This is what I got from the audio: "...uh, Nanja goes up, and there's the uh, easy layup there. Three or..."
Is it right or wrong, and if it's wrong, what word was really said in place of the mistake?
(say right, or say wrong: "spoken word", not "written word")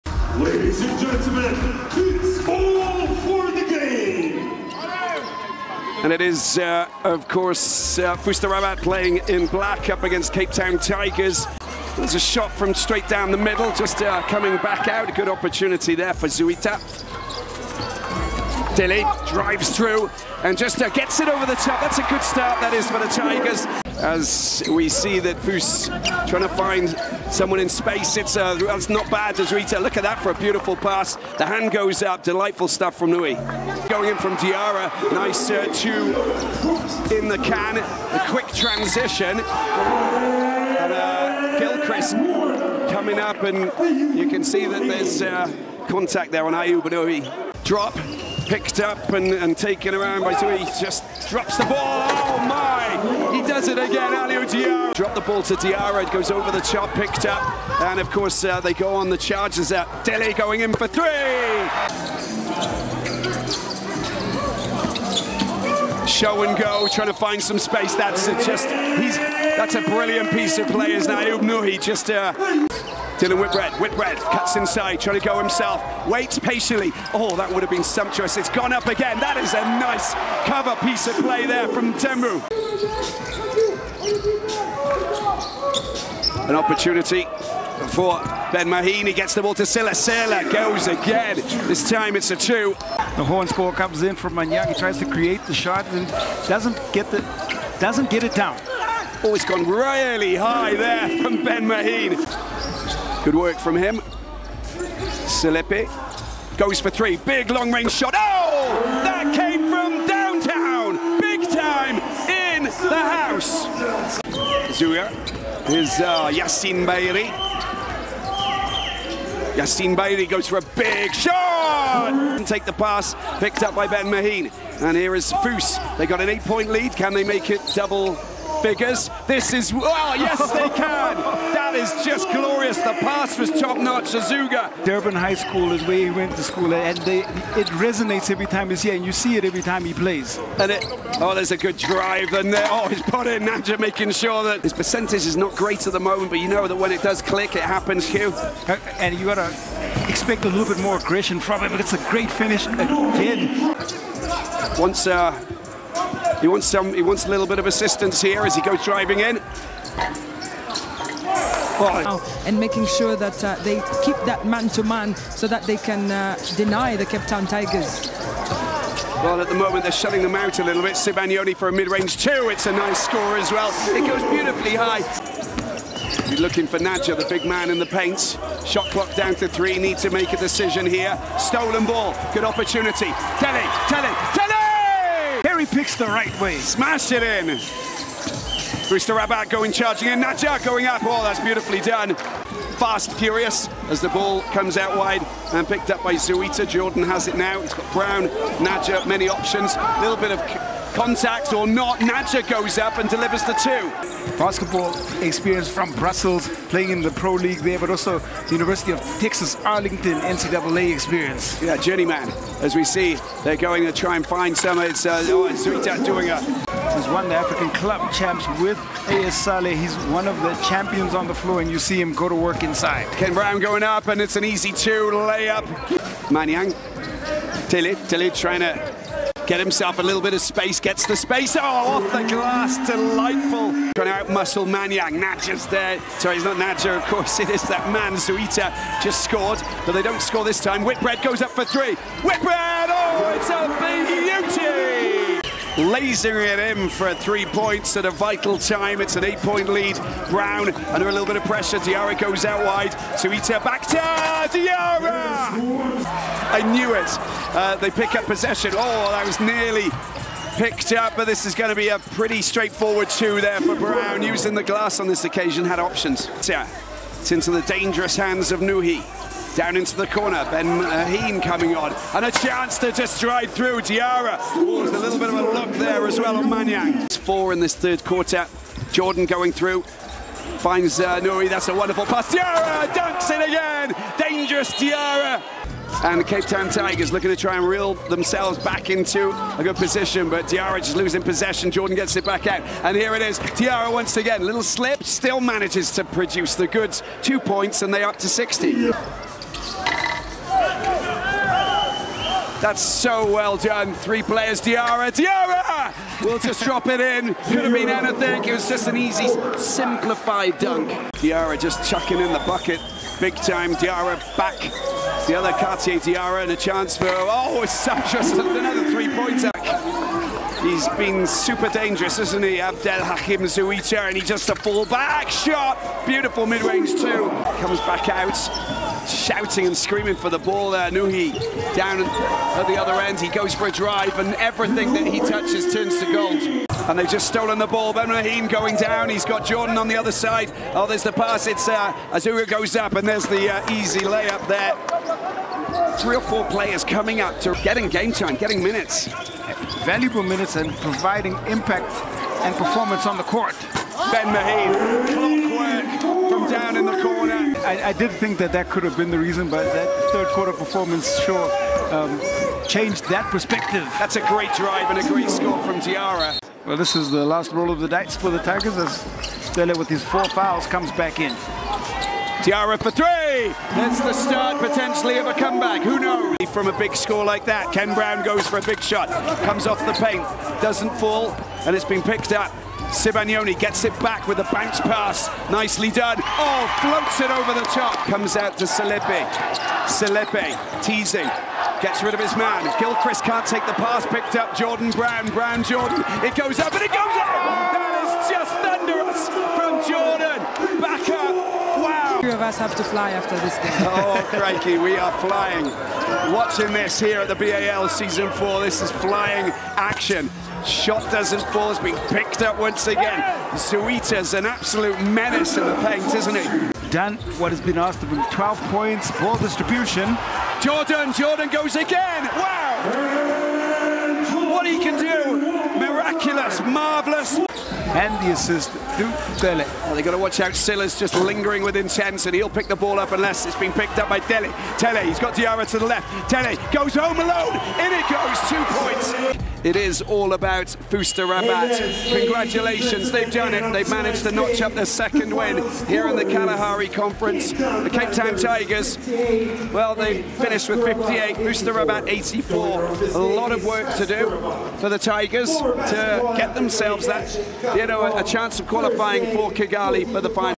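wrong: "Azura", not "Nanja".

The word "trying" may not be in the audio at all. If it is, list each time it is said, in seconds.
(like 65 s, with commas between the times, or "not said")
26 s, 66 s, 75 s, 228 s, 233 s.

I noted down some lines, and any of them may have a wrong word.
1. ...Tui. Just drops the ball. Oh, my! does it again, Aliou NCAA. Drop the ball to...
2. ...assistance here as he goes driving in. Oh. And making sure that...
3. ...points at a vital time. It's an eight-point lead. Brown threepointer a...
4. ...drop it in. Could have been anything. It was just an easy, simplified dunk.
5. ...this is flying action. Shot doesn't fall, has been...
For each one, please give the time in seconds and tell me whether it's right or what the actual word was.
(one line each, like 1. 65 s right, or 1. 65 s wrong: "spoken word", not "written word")
1. 50 s wrong: "Diarra", not "NCAA"
2. 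157 s right
3. 247 s wrong: "under", not "threepointer"
4. 306 s right
5. 408 s right.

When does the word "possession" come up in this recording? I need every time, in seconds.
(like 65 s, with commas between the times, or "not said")
258 s, 291 s.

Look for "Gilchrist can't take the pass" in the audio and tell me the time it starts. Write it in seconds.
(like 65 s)
392 s.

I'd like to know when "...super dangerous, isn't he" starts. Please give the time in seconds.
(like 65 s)
321 s.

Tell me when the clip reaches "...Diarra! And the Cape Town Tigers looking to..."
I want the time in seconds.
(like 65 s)
284 s.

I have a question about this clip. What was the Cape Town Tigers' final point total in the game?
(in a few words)
58.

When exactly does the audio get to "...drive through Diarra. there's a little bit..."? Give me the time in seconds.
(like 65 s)
273 s.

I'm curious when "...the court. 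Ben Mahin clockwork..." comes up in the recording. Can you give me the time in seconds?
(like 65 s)
353 s.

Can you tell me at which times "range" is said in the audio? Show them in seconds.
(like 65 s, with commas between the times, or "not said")
107 s, 171 s, 326 s.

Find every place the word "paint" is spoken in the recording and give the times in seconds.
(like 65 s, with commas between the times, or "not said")
177 s, 379 s, 415 s.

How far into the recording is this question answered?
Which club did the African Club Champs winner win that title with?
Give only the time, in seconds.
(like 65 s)
219 s.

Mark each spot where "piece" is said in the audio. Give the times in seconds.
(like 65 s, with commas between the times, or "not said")
70 s, 80 s.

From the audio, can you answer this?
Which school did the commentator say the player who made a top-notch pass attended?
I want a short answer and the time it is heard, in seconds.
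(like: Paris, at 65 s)
Durban High School, at 134 s.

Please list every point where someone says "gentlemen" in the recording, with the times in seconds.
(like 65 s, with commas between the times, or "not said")
0 s.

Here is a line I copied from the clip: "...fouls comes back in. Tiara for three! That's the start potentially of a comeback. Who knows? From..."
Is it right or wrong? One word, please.
right.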